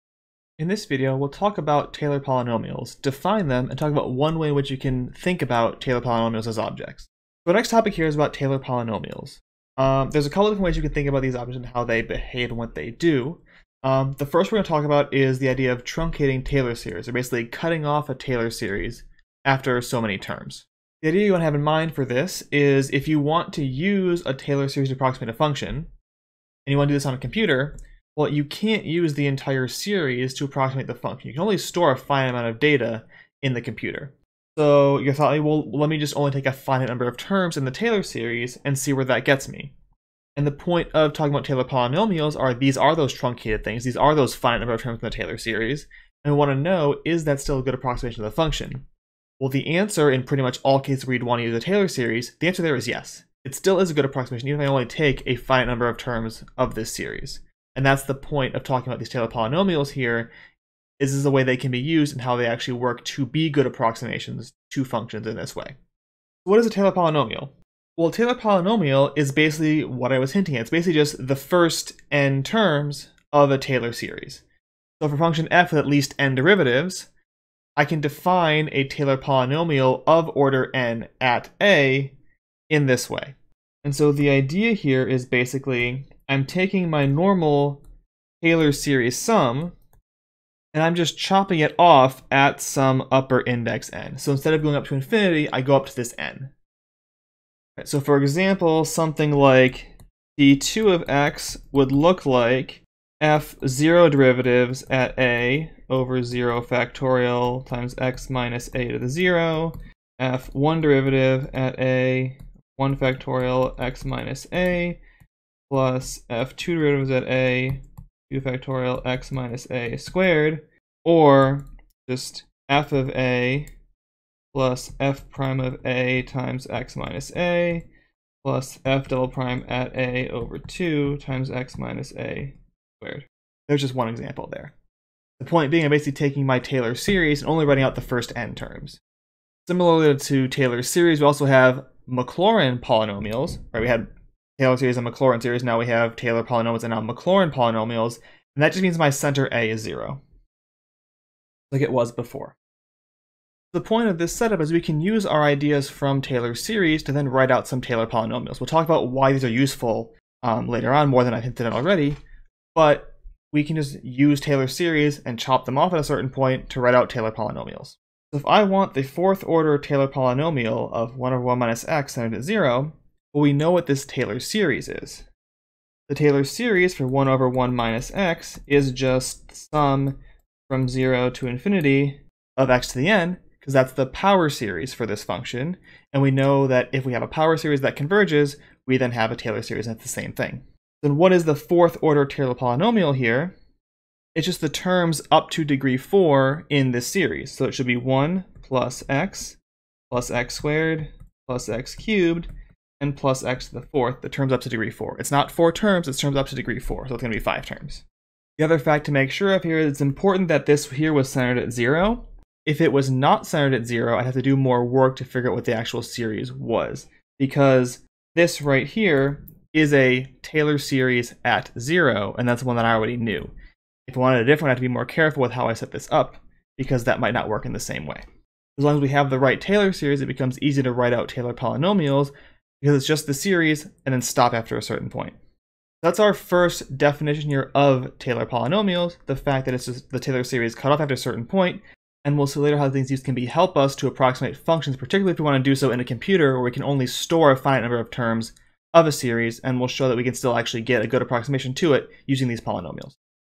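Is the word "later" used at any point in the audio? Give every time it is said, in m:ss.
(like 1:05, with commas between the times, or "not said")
2:40, 4:02.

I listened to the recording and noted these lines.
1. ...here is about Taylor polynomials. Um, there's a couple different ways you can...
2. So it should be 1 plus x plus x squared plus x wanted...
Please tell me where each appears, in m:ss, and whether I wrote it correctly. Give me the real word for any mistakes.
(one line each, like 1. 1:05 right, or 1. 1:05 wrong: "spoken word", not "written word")
1. 0:07 right
2. 3:17 wrong: "cubed", not "wanted".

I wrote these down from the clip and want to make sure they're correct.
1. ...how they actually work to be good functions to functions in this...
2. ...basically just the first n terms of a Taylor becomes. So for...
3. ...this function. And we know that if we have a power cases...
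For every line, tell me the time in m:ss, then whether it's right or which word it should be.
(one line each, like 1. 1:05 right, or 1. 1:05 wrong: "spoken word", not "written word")
1. 1:02 wrong: "approximations", not "functions"
2. 1:10 wrong: "series", not "becomes"
3. 3:05 wrong: "series", not "cases".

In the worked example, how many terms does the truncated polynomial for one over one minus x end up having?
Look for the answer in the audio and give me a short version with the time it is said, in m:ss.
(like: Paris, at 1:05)
5, at 3:27.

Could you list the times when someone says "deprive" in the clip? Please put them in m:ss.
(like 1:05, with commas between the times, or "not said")
not said.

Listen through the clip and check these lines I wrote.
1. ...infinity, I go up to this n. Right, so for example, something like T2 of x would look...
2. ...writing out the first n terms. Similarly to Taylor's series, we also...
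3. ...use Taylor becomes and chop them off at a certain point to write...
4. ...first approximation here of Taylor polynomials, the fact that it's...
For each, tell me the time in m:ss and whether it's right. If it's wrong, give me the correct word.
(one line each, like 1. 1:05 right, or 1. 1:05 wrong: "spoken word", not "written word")
1. 1:34 right
2. 2:17 right
3. 2:44 wrong: "series", not "becomes"
4. 3:56 wrong: "definition", not "approximation".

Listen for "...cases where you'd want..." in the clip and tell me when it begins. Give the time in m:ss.
0:50.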